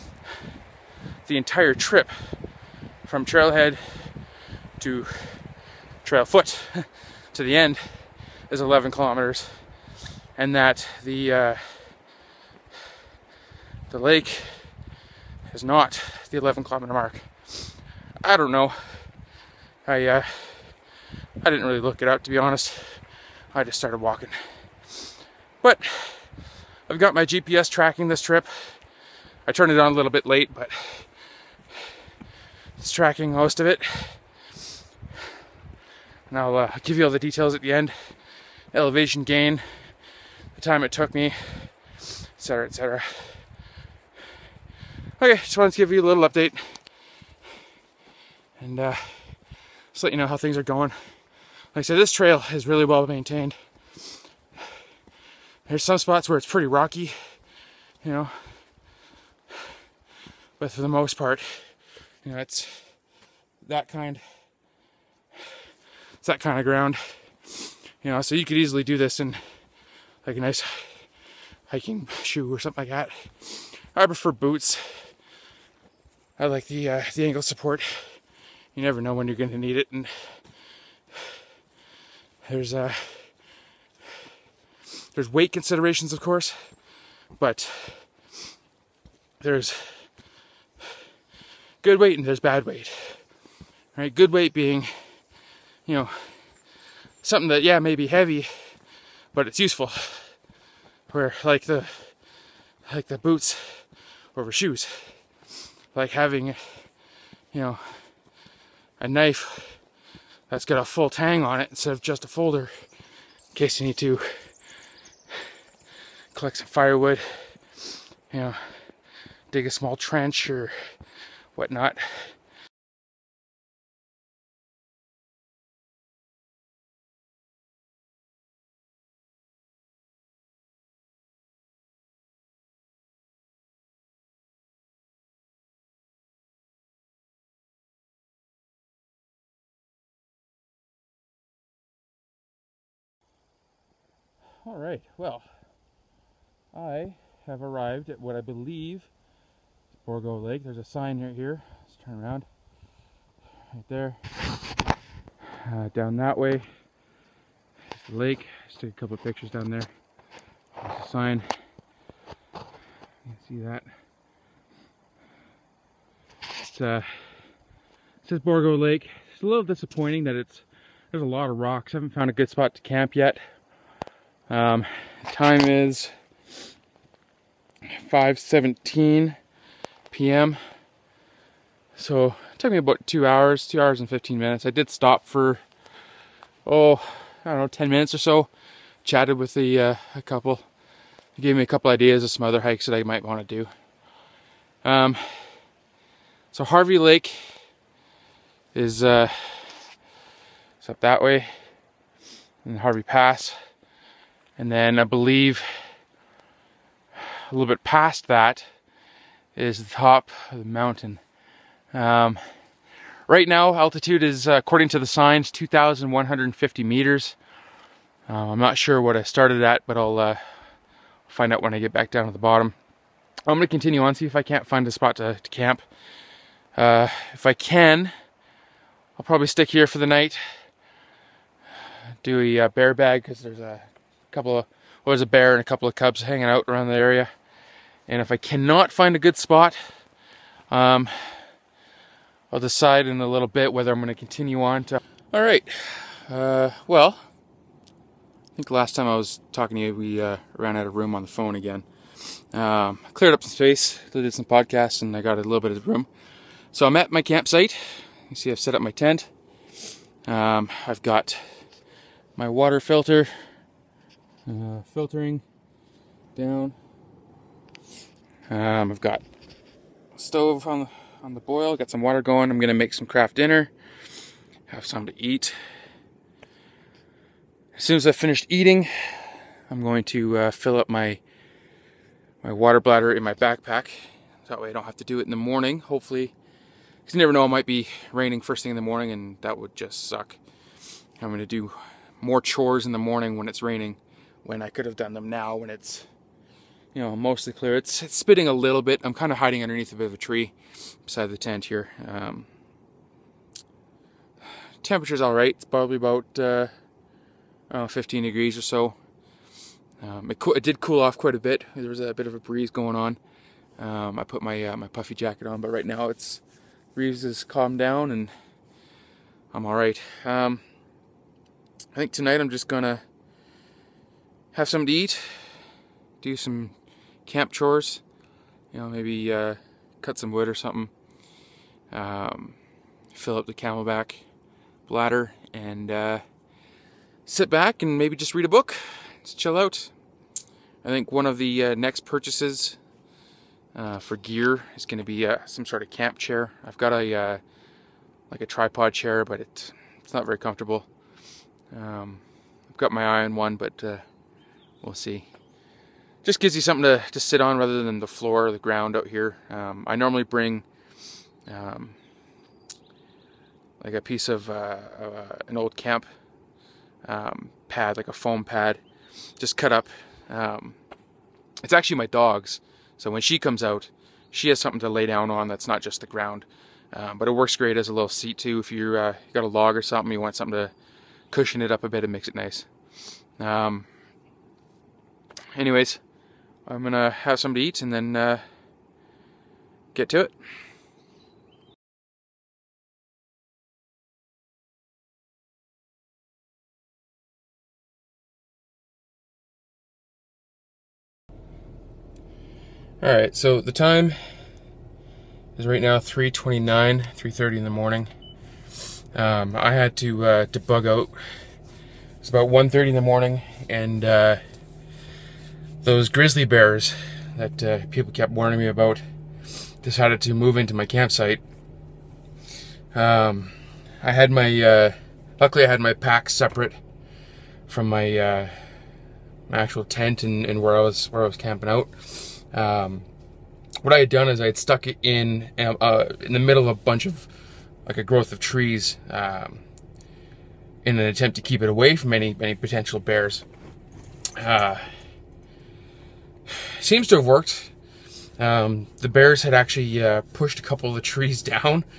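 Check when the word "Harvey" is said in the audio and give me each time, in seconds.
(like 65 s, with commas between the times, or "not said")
196 s, 202 s.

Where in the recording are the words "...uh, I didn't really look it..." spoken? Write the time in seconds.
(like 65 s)
20 s.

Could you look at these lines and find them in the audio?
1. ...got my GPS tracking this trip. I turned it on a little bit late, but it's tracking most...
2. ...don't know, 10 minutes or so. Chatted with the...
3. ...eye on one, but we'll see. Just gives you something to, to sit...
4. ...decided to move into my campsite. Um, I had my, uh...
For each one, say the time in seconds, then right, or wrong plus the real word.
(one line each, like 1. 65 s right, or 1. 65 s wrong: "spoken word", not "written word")
1. 26 s right
2. 187 s right
3. 353 s right
4. 419 s right.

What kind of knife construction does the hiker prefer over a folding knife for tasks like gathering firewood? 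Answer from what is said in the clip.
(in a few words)
full tang.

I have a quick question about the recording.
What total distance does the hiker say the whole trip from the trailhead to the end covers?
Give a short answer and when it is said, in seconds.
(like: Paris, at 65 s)
11 kilometers, at 8 s.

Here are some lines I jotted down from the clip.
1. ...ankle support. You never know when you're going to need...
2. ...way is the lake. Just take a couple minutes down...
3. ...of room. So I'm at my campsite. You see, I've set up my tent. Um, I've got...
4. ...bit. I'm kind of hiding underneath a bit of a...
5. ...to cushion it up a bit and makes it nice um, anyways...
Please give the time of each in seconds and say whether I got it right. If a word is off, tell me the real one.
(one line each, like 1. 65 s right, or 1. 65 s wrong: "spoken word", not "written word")
1. 77 s right
2. 156 s wrong: "pictures", not "minutes"
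3. 255 s right
4. 298 s right
5. 380 s right.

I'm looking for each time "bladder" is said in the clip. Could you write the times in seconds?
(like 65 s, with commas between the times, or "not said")
282 s, 334 s.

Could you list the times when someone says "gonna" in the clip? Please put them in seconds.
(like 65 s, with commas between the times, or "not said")
272 s, 322 s, 386 s.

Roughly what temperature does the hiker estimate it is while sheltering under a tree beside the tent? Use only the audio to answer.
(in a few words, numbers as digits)
15 degrees.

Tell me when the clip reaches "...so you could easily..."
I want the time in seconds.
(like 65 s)
68 s.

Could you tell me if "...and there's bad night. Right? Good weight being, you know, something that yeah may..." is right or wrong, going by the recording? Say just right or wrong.
wrong.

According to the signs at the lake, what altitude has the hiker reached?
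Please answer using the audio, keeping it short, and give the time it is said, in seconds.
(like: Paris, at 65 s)
2,150 meters, at 215 s.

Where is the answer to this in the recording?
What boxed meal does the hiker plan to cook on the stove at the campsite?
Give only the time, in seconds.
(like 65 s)
273 s.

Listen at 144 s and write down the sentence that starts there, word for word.
All right, well, I have arrived at what I believe is Bourgeau Lake.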